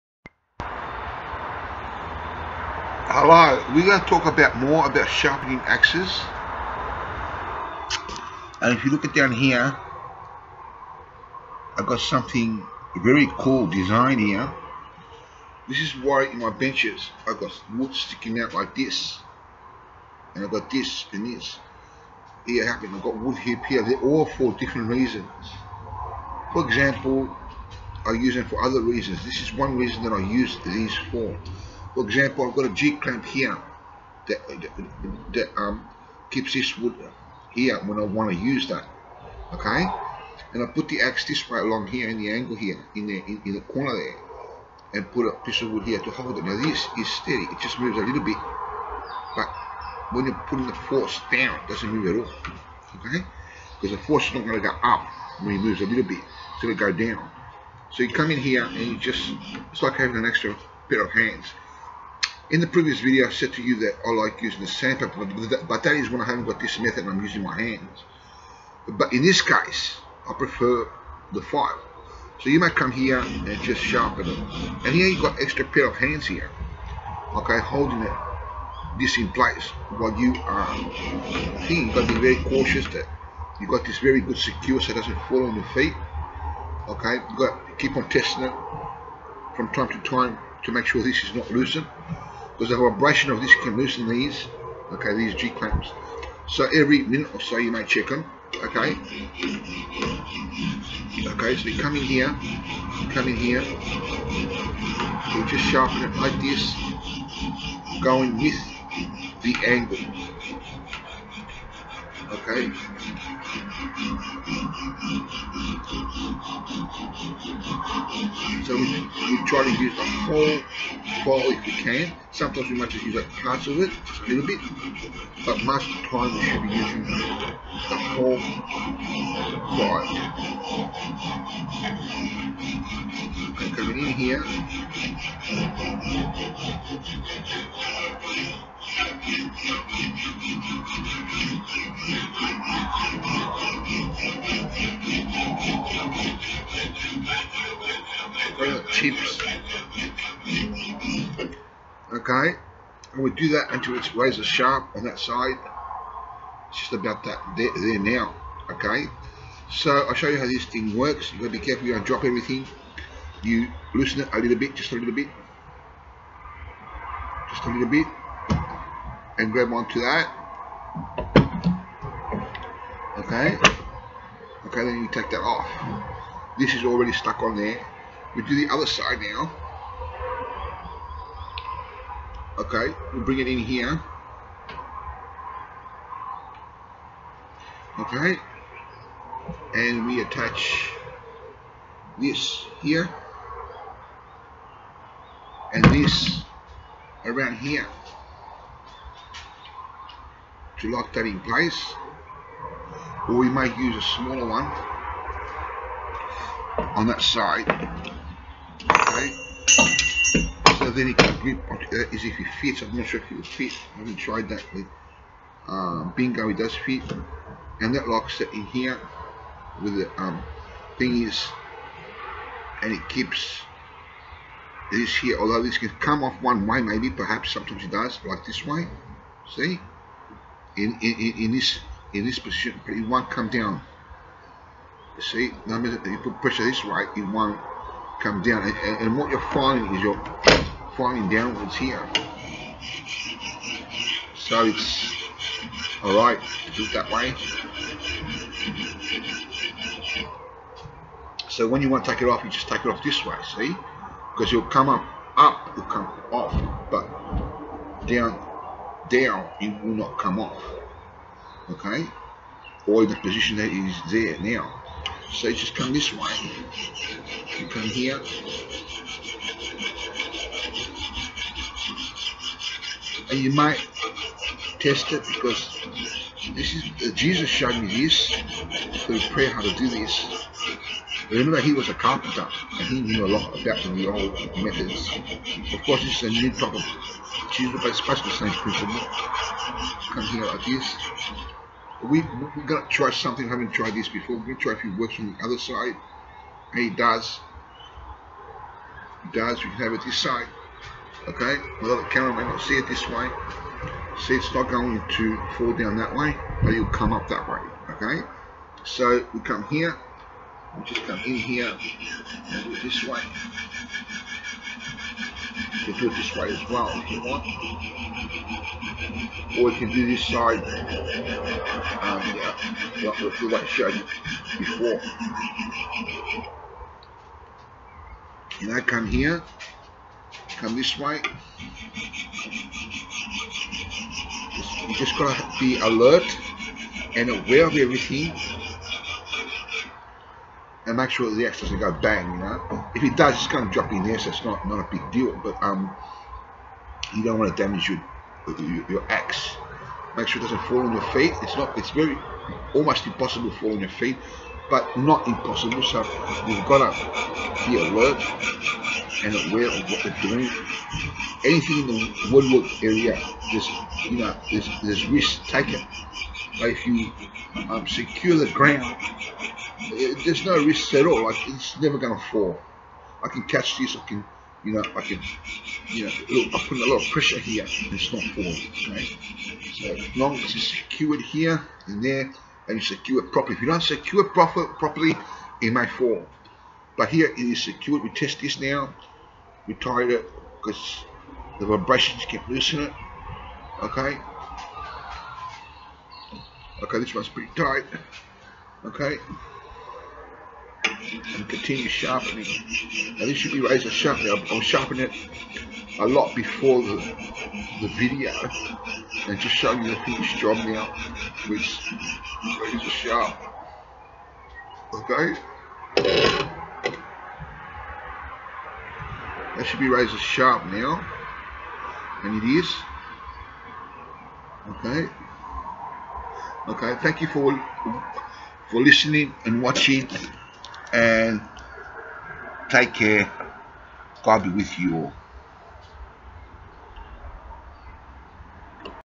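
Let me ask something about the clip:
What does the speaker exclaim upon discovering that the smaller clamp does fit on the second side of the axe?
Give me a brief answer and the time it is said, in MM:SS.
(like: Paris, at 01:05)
Bingo, at 03:36.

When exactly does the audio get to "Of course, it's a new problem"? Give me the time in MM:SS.
04:45.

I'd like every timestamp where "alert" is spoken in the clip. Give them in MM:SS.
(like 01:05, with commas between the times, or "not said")
05:35, 05:57.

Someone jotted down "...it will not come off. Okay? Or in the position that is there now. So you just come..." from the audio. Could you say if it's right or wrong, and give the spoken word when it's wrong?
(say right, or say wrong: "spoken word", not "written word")
right.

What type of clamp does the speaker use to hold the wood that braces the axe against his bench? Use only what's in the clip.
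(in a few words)
G-clamp.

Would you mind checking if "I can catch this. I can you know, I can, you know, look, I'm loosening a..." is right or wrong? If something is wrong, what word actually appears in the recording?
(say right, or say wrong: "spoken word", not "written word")
wrong: "putting", not "loosening".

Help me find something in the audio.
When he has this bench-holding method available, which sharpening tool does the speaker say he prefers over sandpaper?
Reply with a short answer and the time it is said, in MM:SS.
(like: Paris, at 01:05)
The file, at 01:11.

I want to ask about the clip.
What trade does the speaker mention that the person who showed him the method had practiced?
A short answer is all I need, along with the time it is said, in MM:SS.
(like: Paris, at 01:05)
Carpenter, at 04:41.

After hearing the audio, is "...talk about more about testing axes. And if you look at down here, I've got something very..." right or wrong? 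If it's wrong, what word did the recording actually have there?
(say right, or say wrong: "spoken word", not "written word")
wrong: "sharpening", not "testing".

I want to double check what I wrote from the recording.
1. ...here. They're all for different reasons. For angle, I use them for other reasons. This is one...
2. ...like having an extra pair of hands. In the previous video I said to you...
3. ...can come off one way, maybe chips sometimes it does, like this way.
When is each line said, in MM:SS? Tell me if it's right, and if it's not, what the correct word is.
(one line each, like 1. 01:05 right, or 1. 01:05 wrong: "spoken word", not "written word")
1. 00:23 wrong: "example", not "angle"
2. 00:59 right
3. 03:45 wrong: "perhaps", not "chips".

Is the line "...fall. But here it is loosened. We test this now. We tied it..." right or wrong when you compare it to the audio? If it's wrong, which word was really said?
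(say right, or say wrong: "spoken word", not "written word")
wrong: "secured", not "loosened".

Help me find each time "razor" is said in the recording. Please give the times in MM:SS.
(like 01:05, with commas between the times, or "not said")
02:34, 06:43, 06:52, 06:59.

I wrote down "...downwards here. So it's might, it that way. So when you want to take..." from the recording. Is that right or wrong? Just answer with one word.
wrong.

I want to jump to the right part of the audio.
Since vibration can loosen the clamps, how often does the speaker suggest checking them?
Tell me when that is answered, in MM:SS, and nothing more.
01:36.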